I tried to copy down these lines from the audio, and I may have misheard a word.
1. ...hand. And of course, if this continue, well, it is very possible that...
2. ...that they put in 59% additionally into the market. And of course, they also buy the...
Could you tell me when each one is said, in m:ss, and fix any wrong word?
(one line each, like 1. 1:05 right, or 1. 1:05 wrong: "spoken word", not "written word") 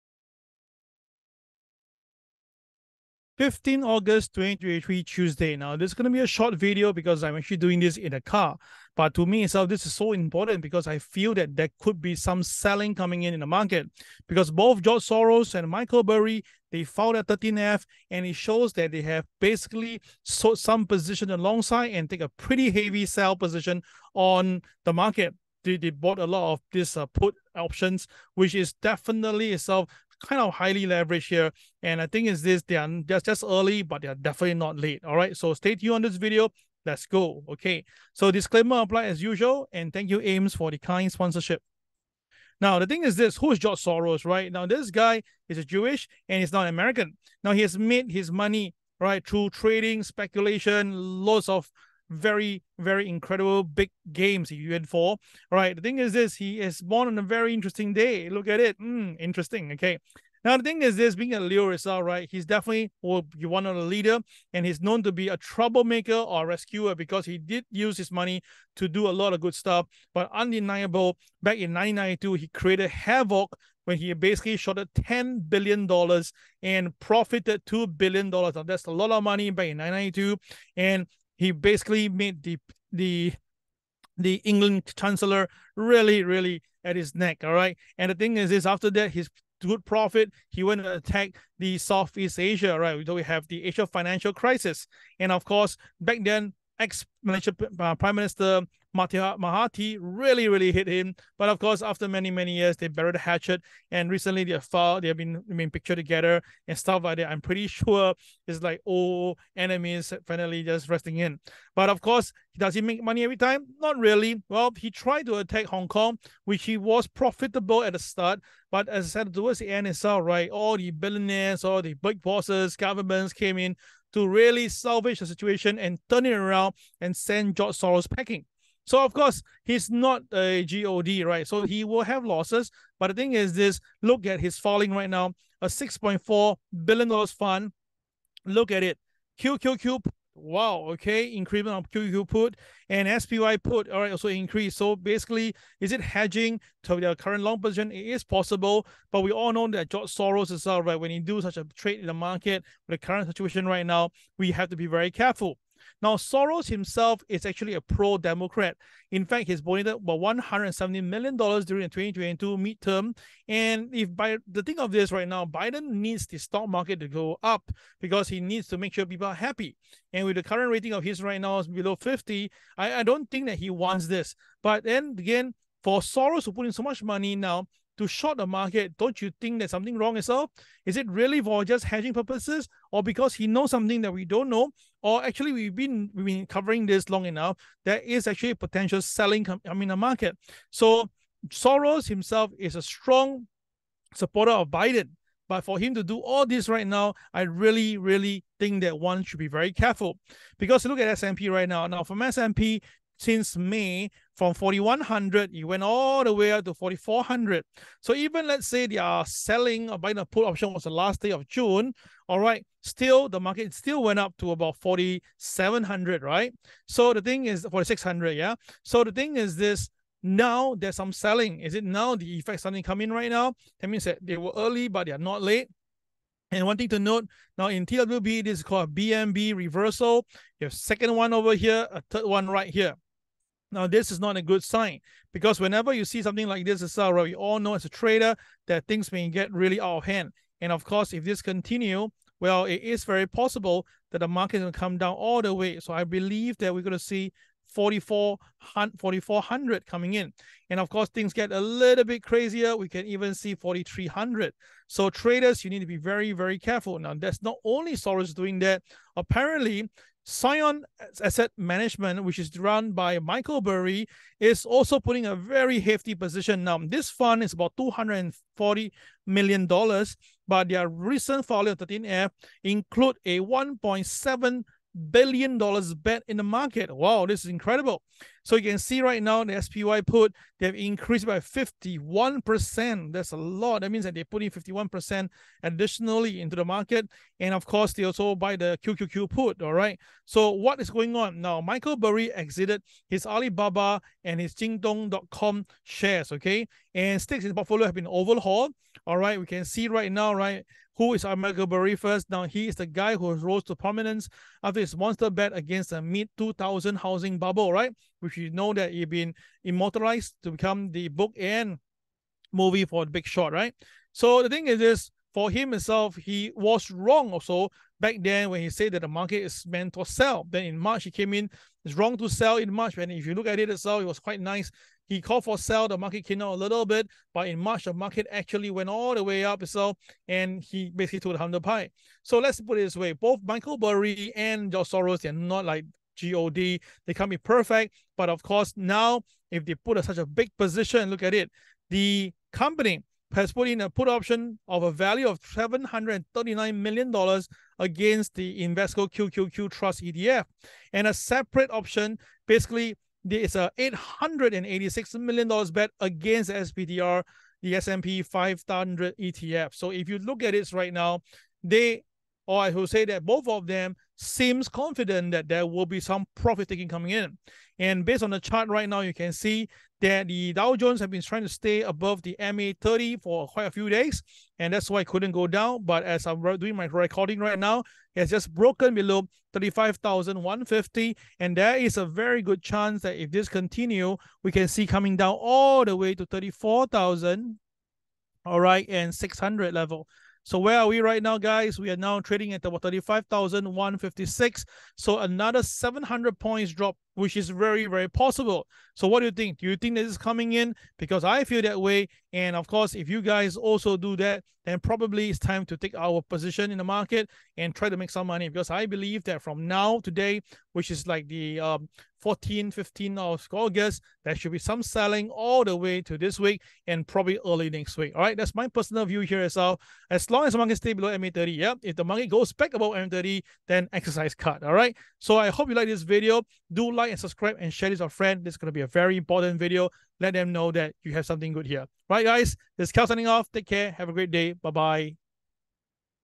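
1. 4:00 right
2. 4:44 wrong: "51", not "59".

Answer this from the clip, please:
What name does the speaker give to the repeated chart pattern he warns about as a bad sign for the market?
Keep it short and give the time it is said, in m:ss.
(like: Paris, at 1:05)
BMB reversal, at 3:48.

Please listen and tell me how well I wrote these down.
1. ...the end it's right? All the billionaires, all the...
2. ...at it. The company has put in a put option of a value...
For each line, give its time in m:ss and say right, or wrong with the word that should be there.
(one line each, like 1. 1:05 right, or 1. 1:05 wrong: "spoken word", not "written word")
1. 1:59 right
2. 5:41 right.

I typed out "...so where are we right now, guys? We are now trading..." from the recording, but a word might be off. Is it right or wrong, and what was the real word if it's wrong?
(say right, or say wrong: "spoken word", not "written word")
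right.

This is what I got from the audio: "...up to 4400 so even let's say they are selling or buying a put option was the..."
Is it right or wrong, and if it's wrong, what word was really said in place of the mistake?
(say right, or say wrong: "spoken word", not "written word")
right.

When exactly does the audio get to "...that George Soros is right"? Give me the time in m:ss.
2:29.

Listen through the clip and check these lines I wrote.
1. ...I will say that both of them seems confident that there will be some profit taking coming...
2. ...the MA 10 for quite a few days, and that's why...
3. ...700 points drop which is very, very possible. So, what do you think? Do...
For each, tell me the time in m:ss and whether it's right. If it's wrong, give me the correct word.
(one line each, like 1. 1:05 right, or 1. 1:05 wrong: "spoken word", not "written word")
1. 6:02 right
2. 6:12 wrong: "30", not "10"
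3. 6:35 right.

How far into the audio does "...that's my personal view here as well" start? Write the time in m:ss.
6:58.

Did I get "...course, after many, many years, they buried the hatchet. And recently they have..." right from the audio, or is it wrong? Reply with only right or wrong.
right.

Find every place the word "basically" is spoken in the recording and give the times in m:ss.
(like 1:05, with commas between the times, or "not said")
0:19, 1:14, 1:21, 2:24, 5:30, 5:52.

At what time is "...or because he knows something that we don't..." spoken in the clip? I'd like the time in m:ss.
3:02.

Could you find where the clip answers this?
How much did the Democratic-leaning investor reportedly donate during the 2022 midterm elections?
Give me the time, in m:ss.
2:40.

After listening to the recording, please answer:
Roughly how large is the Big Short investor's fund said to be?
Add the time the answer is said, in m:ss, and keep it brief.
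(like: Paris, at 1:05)
$240 million, at 4:27.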